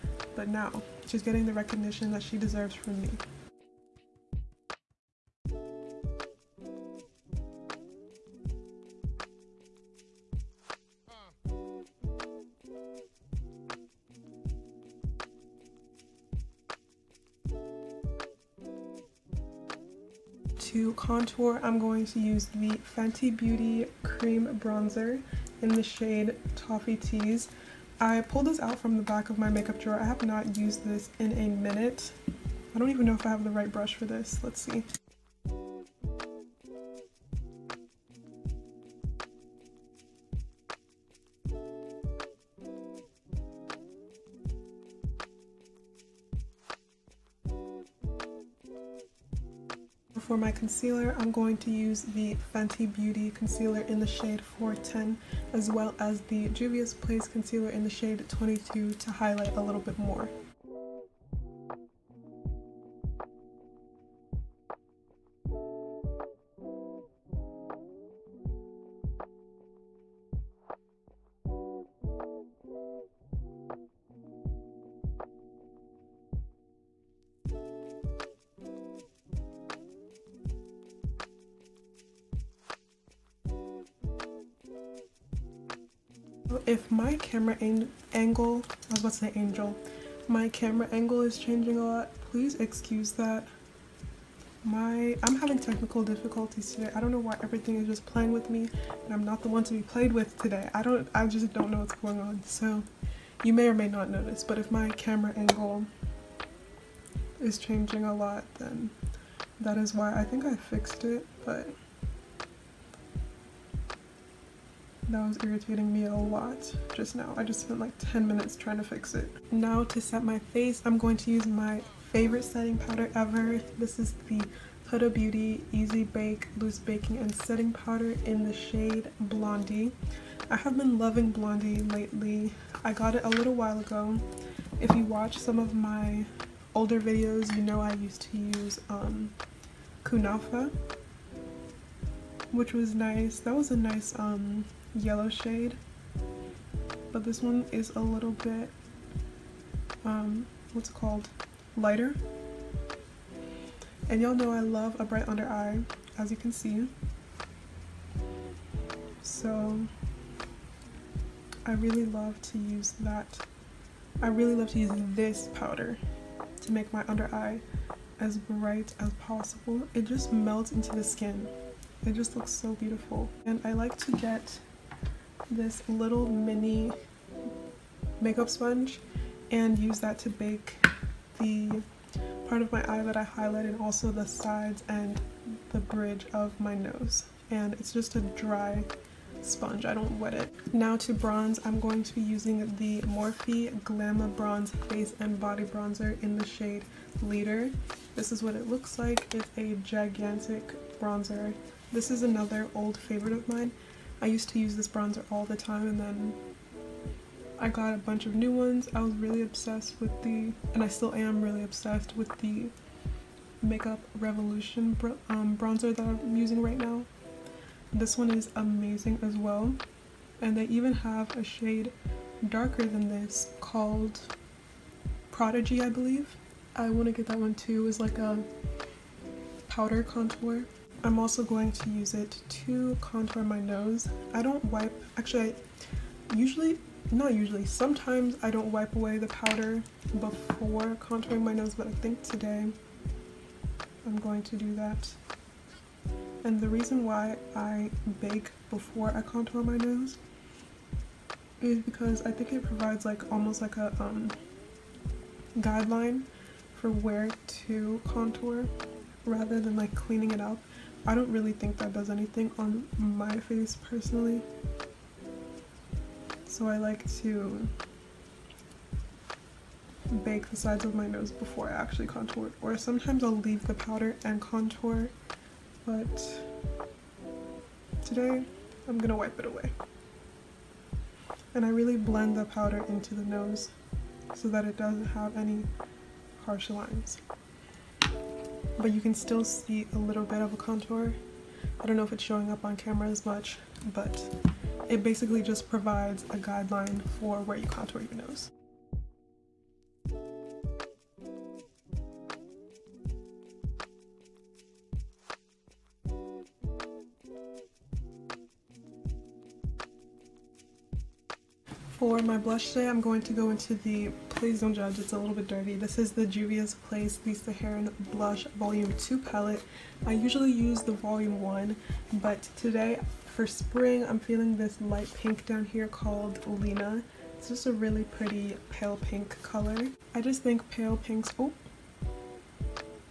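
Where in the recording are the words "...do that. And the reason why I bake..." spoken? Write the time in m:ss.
4:04.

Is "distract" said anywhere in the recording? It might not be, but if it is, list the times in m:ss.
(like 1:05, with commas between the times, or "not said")
not said.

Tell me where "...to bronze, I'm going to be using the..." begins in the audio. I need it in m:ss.
3:10.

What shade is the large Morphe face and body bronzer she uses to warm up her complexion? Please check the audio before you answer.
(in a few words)
Leader.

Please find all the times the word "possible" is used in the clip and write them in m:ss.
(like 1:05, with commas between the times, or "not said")
2:49.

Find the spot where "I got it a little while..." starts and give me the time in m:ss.
2:12.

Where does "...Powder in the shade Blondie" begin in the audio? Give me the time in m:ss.
2:07.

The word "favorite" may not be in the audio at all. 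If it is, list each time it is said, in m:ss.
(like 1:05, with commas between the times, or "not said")
2:02, 3:22.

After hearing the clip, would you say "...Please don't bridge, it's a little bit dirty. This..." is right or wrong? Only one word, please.
wrong.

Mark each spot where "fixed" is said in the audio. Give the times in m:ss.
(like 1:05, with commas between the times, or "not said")
1:50.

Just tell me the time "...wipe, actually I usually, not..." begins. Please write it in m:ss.
3:54.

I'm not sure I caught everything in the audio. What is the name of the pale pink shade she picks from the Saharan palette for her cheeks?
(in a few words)
Lena.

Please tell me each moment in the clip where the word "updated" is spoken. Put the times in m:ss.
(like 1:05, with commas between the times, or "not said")
not said.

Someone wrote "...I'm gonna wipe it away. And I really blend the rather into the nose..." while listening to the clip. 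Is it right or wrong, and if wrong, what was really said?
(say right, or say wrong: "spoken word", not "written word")
wrong: "powder", not "rather".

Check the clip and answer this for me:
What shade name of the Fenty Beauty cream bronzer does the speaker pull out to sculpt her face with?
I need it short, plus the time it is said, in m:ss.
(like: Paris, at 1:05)
Toffee Tease, at 0:26.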